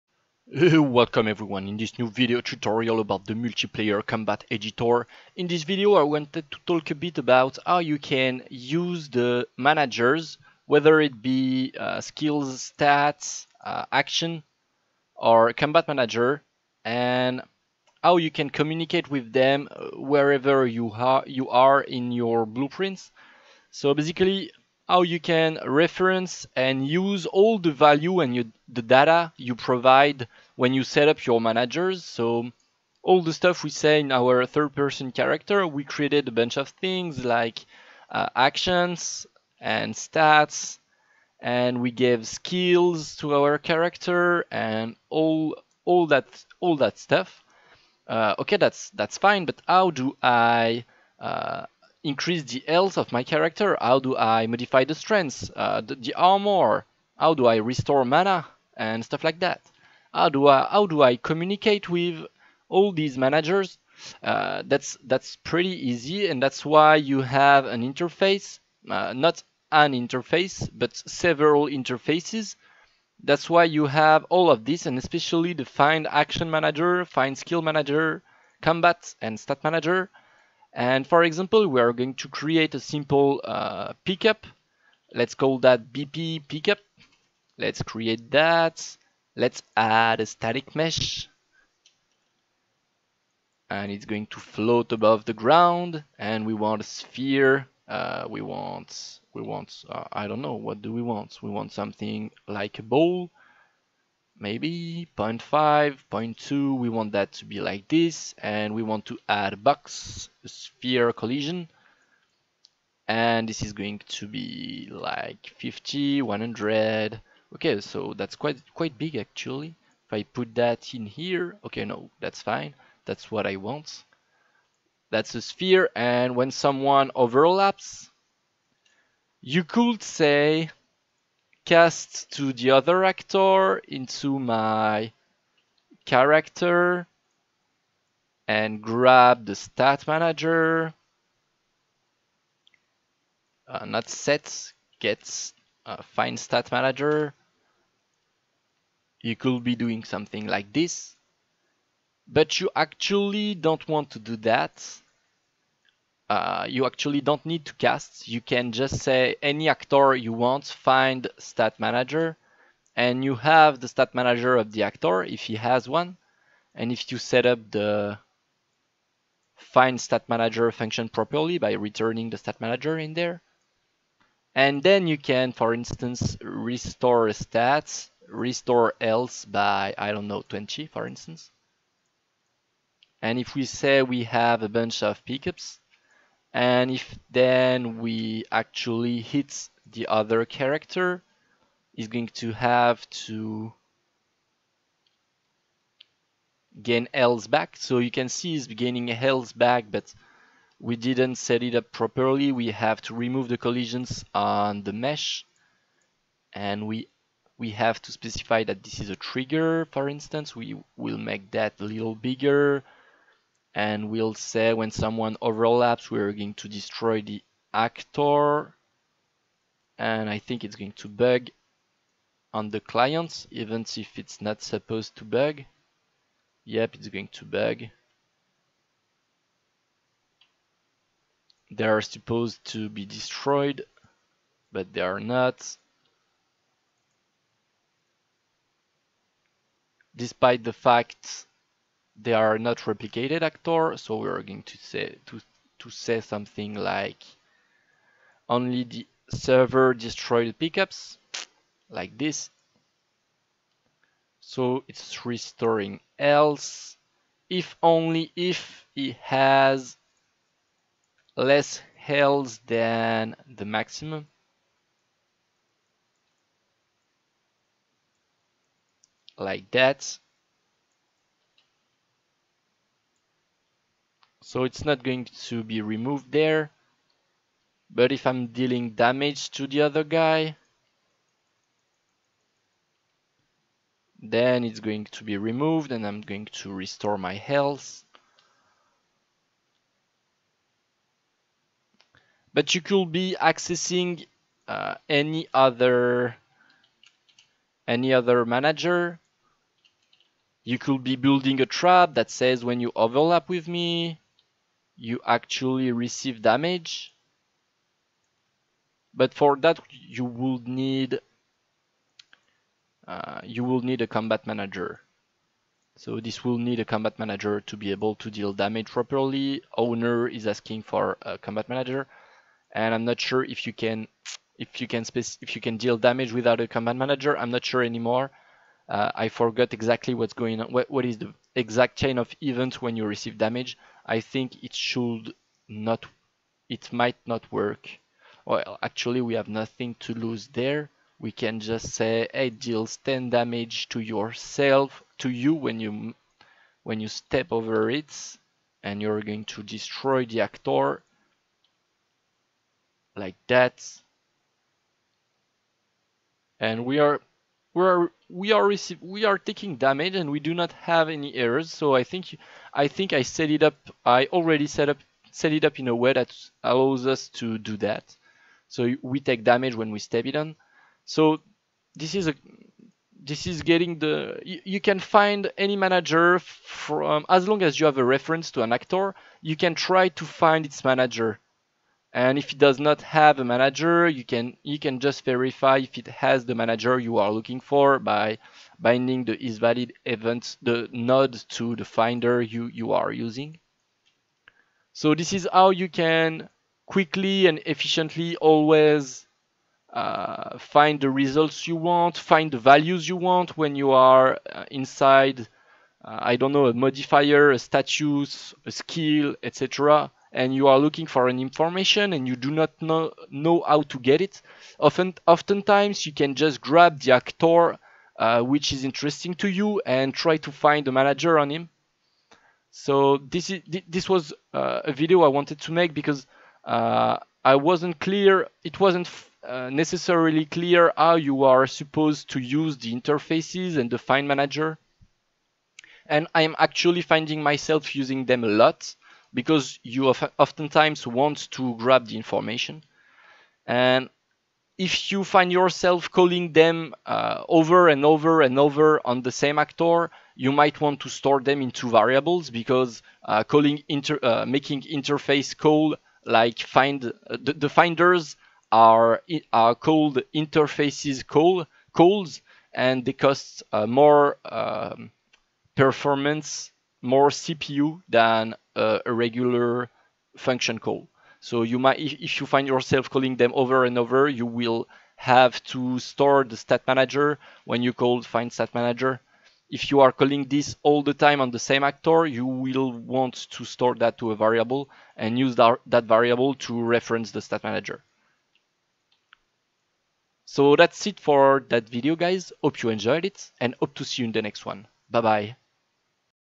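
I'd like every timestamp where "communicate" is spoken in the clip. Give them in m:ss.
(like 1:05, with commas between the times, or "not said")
0:18, 1:01.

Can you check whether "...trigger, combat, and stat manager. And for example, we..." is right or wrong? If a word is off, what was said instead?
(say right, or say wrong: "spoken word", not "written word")
wrong: "manager", not "trigger".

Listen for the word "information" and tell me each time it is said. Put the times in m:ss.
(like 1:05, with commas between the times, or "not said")
6:51, 7:22.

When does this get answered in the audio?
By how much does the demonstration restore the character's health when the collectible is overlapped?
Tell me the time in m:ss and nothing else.
3:00.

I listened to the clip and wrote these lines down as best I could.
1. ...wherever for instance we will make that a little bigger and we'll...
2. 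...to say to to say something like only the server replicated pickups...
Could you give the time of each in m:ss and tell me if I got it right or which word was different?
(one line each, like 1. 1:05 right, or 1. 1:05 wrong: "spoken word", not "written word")
1. 3:29 wrong: "trigger", not "wherever"
2. 4:04 wrong: "destroyed", not "replicated".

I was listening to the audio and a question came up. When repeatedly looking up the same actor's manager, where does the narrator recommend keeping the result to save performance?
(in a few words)
a variable.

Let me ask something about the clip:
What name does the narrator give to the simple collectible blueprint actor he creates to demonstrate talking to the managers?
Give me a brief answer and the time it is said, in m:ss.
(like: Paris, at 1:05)
BP pickup, at 1:25.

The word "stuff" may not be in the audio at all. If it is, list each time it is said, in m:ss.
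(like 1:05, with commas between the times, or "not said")
0:33, 0:46, 0:59.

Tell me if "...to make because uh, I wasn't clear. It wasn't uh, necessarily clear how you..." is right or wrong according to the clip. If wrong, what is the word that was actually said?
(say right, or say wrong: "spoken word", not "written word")
right.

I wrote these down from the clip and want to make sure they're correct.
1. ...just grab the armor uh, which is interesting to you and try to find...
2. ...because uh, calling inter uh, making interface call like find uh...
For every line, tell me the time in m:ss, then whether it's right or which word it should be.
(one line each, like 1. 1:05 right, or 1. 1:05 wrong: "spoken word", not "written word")
1. 6:56 wrong: "actor", not "armor"
2. 7:32 right.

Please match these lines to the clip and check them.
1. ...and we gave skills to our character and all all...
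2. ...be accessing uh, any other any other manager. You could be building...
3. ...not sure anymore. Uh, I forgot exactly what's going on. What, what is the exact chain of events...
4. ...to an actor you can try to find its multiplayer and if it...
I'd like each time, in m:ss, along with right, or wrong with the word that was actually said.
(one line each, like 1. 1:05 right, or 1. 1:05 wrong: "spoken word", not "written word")
1. 0:41 right
2. 4:53 right
3. 5:27 right
4. 6:18 wrong: "manager", not "multiplayer".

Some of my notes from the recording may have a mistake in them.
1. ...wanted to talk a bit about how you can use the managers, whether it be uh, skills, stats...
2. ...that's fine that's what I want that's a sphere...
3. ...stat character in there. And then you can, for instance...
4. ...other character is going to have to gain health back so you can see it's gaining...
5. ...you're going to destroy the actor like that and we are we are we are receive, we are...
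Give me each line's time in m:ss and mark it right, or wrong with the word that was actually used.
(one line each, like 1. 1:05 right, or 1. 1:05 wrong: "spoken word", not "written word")
1. 0:06 right
2. 2:02 right
3. 2:52 wrong: "manager", not "character"
4. 3:10 right
5. 5:49 right.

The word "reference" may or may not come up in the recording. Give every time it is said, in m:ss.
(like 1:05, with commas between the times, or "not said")
0:25, 6:18, 8:06.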